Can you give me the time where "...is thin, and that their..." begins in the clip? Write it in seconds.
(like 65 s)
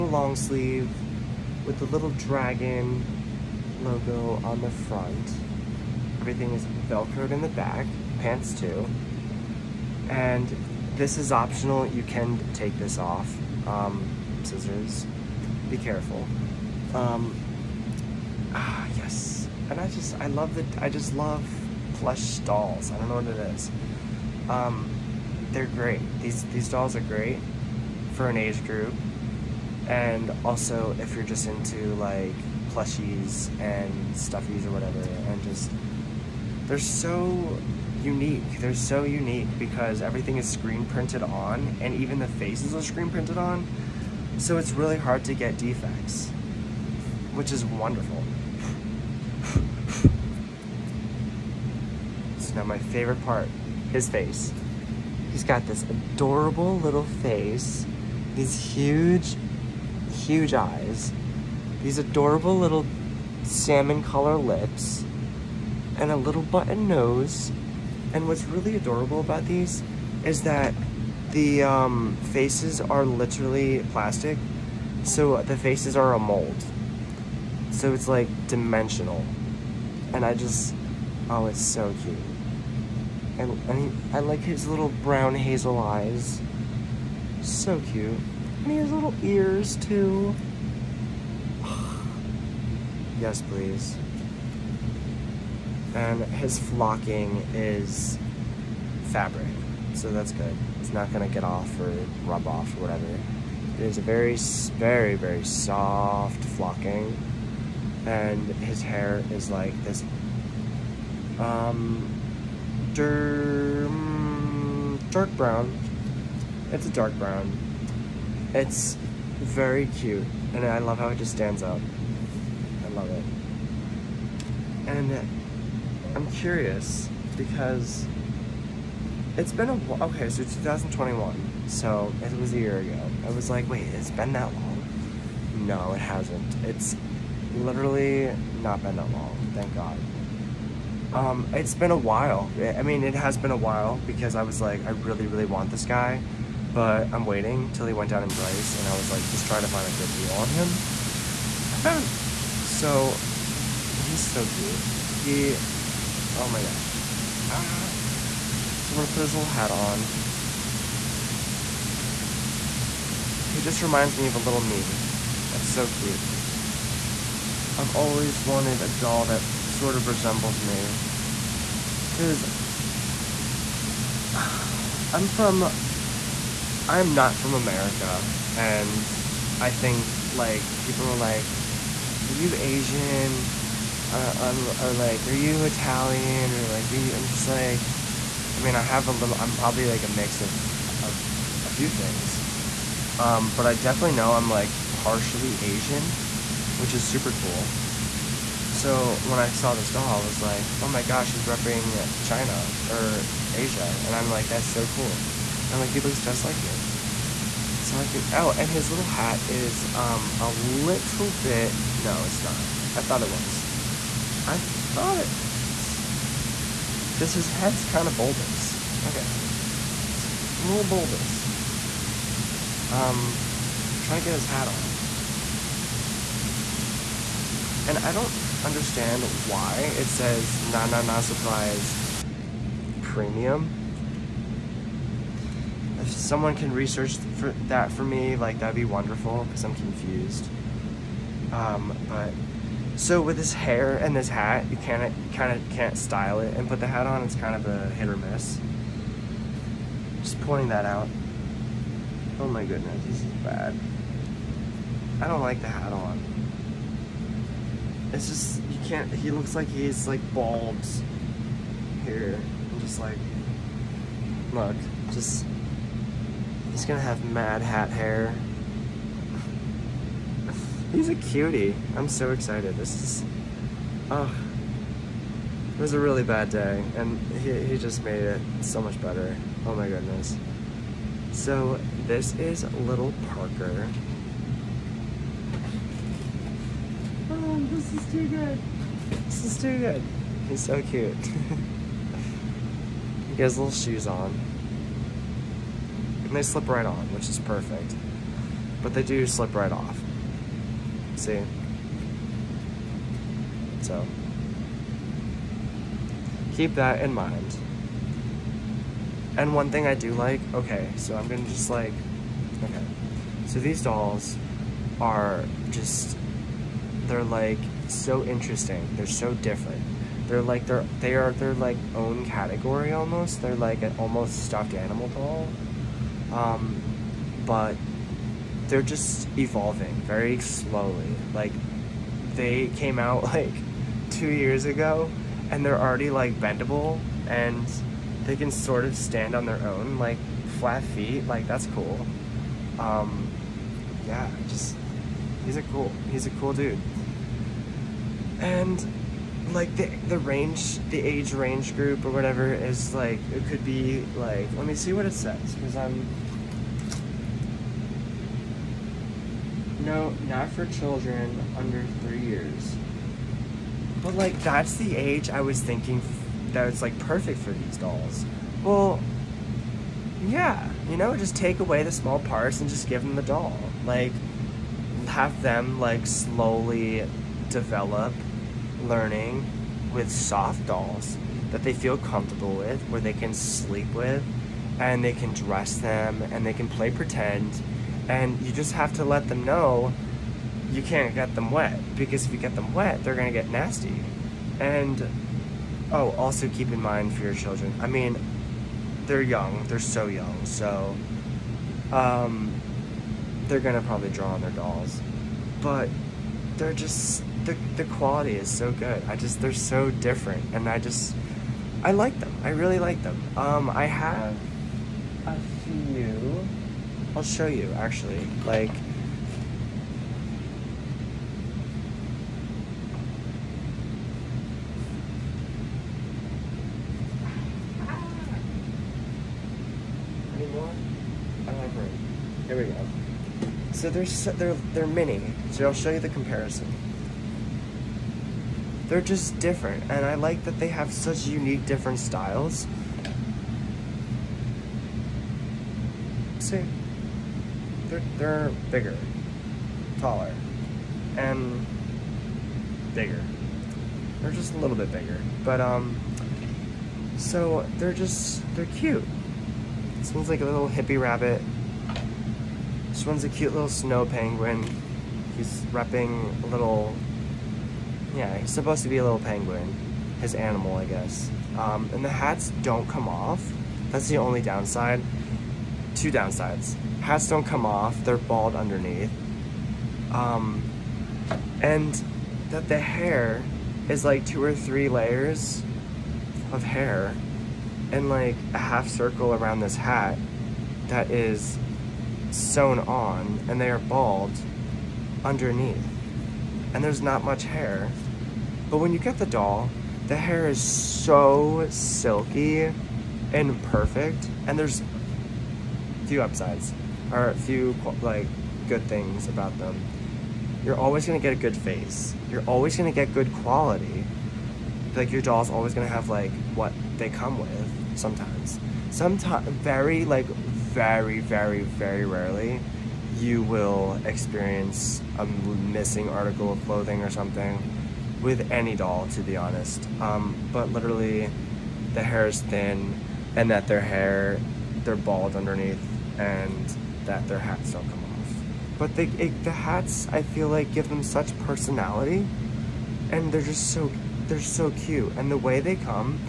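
532 s.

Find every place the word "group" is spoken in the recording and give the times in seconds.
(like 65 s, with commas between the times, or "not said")
28 s, 351 s.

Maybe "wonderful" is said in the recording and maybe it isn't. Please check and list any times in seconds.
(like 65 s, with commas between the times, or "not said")
47 s, 238 s.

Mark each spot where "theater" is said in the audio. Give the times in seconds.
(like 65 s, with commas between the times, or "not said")
not said.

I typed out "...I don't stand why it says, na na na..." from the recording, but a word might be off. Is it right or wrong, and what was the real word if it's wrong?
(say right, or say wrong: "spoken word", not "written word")
wrong: "understand", not "stand".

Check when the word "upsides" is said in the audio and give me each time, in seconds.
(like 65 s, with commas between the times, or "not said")
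506 s.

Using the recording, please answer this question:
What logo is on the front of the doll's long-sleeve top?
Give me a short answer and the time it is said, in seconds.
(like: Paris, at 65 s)
Little dragon, at 1 s.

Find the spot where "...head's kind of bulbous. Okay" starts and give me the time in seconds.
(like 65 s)
217 s.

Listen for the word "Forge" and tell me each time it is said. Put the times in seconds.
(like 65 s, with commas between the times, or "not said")
not said.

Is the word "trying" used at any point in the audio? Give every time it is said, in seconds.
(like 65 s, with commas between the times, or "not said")
149 s, 224 s.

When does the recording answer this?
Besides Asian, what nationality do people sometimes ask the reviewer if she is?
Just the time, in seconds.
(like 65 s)
185 s.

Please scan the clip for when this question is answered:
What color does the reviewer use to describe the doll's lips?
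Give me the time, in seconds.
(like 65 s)
63 s.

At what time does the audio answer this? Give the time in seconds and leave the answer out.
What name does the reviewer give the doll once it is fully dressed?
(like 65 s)
283 s.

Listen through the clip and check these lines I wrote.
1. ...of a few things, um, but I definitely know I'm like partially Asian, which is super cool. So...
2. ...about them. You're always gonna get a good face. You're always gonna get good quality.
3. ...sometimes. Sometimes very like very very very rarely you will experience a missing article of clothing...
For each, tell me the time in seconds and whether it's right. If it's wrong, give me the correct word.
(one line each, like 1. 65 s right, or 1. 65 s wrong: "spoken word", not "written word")
1. 191 s right
2. 509 s right
3. 517 s right.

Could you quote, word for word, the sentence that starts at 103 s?
It is a very, very, very soft flocking.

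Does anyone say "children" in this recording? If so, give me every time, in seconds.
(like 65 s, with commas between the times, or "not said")
360 s, 397 s.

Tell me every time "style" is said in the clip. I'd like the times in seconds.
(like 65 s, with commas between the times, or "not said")
245 s, 441 s.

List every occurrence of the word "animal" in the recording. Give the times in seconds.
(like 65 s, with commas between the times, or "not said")
324 s, 470 s.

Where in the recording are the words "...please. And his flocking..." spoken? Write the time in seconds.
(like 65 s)
93 s.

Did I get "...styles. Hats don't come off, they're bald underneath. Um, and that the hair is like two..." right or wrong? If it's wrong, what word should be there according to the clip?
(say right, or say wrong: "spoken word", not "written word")
wrong: "downsides", not "styles".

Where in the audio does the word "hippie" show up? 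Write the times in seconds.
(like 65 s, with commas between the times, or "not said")
460 s.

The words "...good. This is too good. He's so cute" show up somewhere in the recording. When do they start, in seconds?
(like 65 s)
288 s.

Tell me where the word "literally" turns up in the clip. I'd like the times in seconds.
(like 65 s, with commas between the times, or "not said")
73 s, 137 s, 530 s.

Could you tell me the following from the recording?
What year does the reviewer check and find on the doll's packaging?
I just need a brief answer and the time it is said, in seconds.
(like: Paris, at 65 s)
2021, at 130 s.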